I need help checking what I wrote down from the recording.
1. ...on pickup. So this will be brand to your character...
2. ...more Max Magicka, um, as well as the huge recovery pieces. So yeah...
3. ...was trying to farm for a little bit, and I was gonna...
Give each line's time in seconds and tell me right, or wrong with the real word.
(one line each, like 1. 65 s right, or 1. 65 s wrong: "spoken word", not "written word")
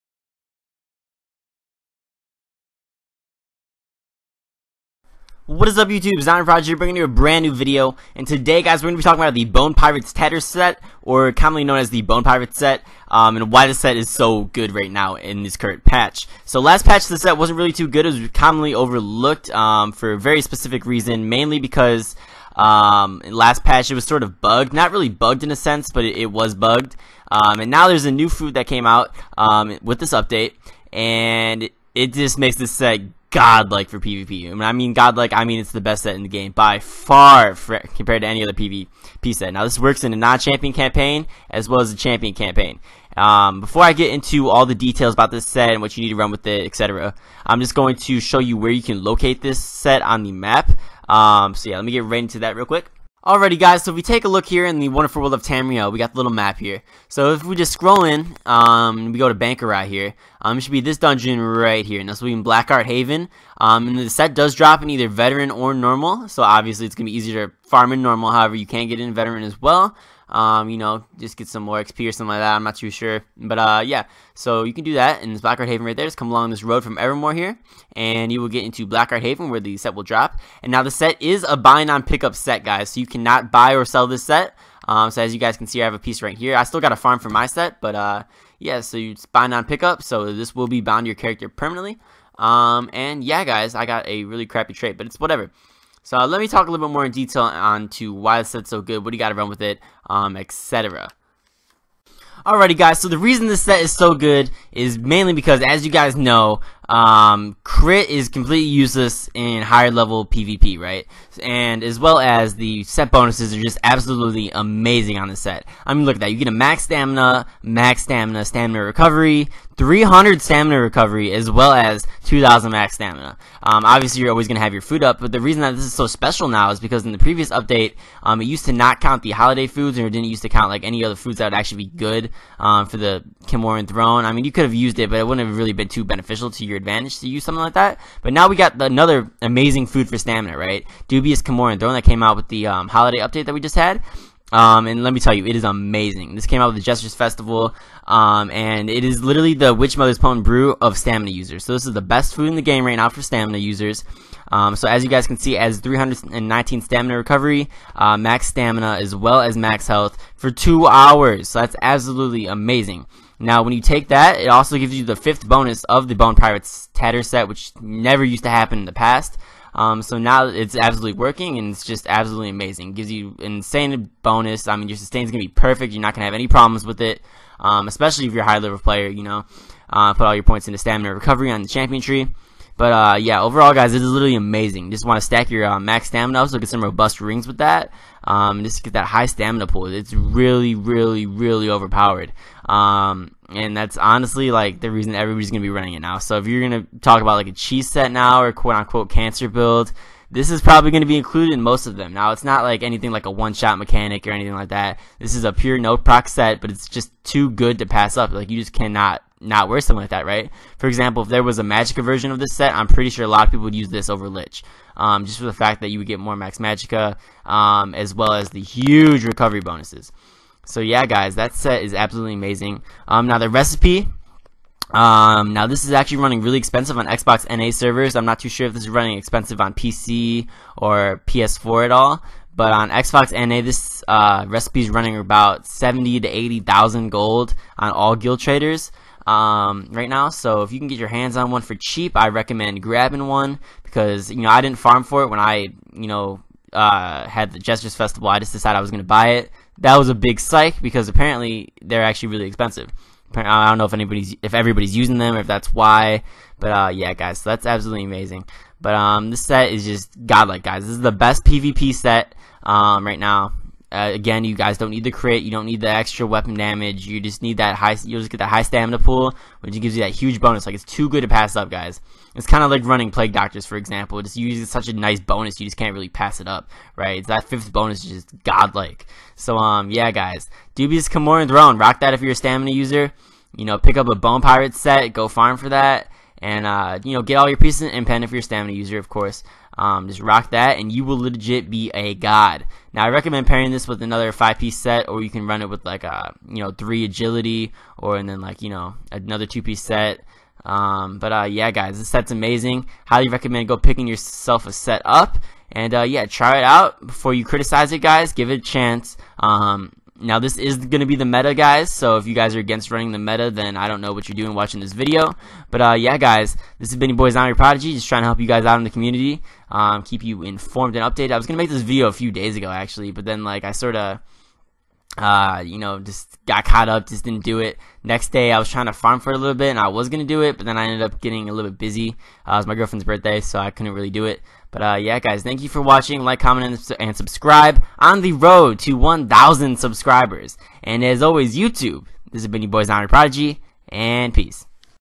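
1. 89 s wrong: "bound", not "brand"
2. 216 s wrong: "bonuses", not "pieces"
3. 328 s right.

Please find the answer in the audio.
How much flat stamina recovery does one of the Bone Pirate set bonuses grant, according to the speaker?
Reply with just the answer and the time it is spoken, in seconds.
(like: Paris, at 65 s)
300, at 119 s.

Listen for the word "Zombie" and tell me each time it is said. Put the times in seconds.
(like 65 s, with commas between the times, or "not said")
6 s, 317 s.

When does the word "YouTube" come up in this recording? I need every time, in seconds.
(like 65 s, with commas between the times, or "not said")
5 s, 341 s.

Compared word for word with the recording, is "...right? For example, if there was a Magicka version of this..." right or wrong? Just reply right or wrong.
right.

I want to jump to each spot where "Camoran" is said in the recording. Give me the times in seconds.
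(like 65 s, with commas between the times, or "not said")
133 s, 281 s.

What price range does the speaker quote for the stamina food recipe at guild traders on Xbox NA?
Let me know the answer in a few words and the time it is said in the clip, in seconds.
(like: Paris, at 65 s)
70,000 to 80,000 gold, at 235 s.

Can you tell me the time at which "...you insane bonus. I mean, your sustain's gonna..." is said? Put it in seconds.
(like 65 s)
173 s.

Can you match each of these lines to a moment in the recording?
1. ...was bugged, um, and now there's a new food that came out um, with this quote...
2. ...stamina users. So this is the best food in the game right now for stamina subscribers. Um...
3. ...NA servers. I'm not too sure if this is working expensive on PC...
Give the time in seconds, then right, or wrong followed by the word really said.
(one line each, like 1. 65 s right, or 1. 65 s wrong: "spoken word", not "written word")
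1. 26 s wrong: "update", not "quote"
2. 150 s wrong: "users", not "subscribers"
3. 227 s wrong: "running", not "working".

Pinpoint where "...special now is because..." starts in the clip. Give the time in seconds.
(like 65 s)
126 s.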